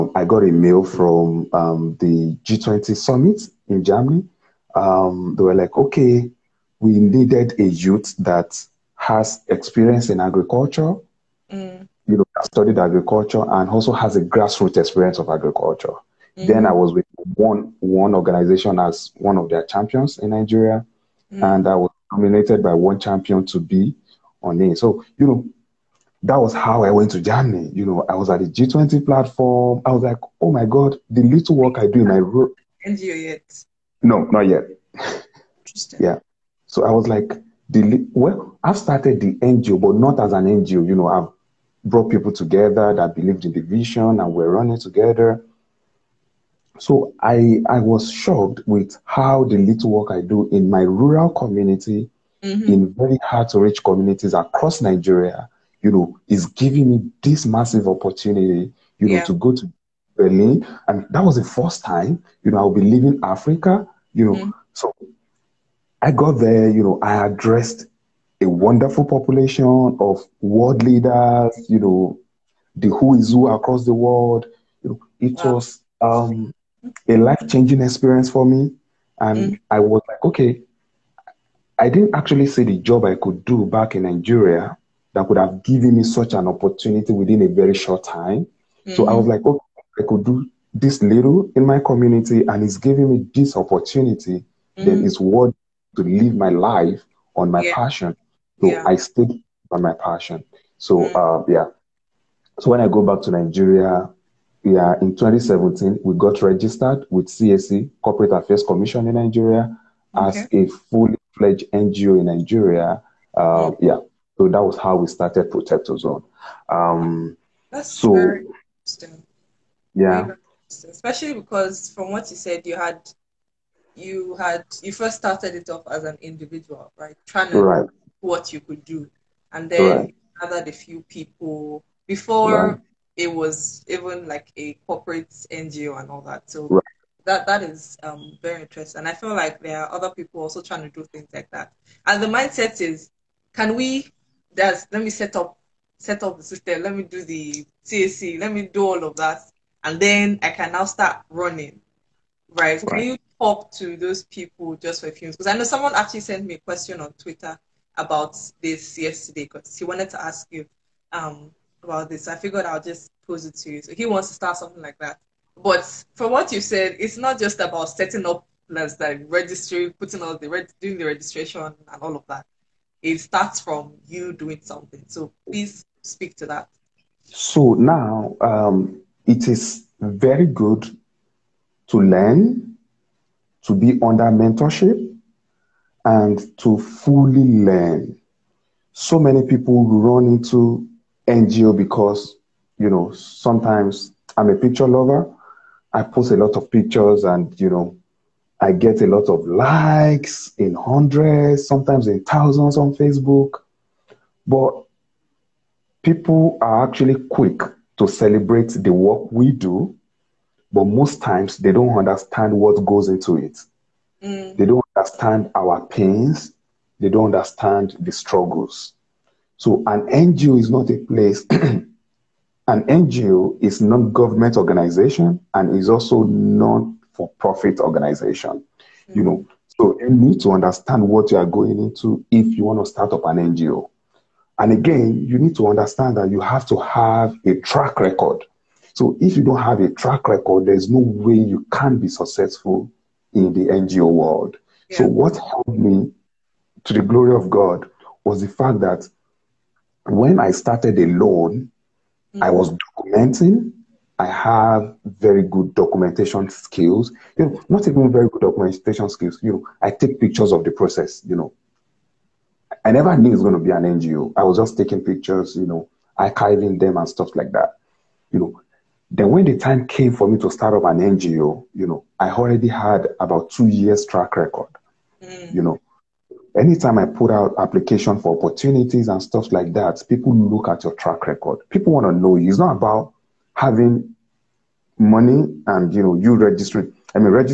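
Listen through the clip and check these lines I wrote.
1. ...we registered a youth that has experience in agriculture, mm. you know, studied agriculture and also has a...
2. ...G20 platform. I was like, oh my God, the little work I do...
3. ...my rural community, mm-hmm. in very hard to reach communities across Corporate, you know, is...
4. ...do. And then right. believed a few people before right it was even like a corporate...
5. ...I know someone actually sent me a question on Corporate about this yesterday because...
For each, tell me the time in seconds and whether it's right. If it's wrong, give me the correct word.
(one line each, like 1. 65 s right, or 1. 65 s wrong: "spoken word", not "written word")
1. 6 s wrong: "needed", not "registered"
2. 28 s right
3. 50 s wrong: "Nigeria", not "Corporate"
4. 128 s wrong: "gathered", not "believed"
5. 155 s wrong: "Twitter", not "Corporate".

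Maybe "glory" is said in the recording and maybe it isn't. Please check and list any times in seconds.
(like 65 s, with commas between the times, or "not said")
247 s.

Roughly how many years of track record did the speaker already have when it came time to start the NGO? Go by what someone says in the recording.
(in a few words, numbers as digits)
2 years.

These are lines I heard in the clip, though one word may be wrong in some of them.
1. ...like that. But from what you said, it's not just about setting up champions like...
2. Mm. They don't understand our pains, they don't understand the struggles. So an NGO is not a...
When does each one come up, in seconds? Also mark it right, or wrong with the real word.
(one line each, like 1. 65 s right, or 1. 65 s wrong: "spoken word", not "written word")
1. 164 s wrong: "plans", not "champions"
2. 214 s right.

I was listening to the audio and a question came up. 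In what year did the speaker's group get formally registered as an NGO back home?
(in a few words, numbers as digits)
2017.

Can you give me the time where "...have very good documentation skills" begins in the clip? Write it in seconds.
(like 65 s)
254 s.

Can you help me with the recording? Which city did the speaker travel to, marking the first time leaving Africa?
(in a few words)
Berlin.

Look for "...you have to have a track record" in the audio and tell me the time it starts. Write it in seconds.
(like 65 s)
236 s.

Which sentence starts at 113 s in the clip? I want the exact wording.
Um, yeah, so that was how we started Protect Ozone.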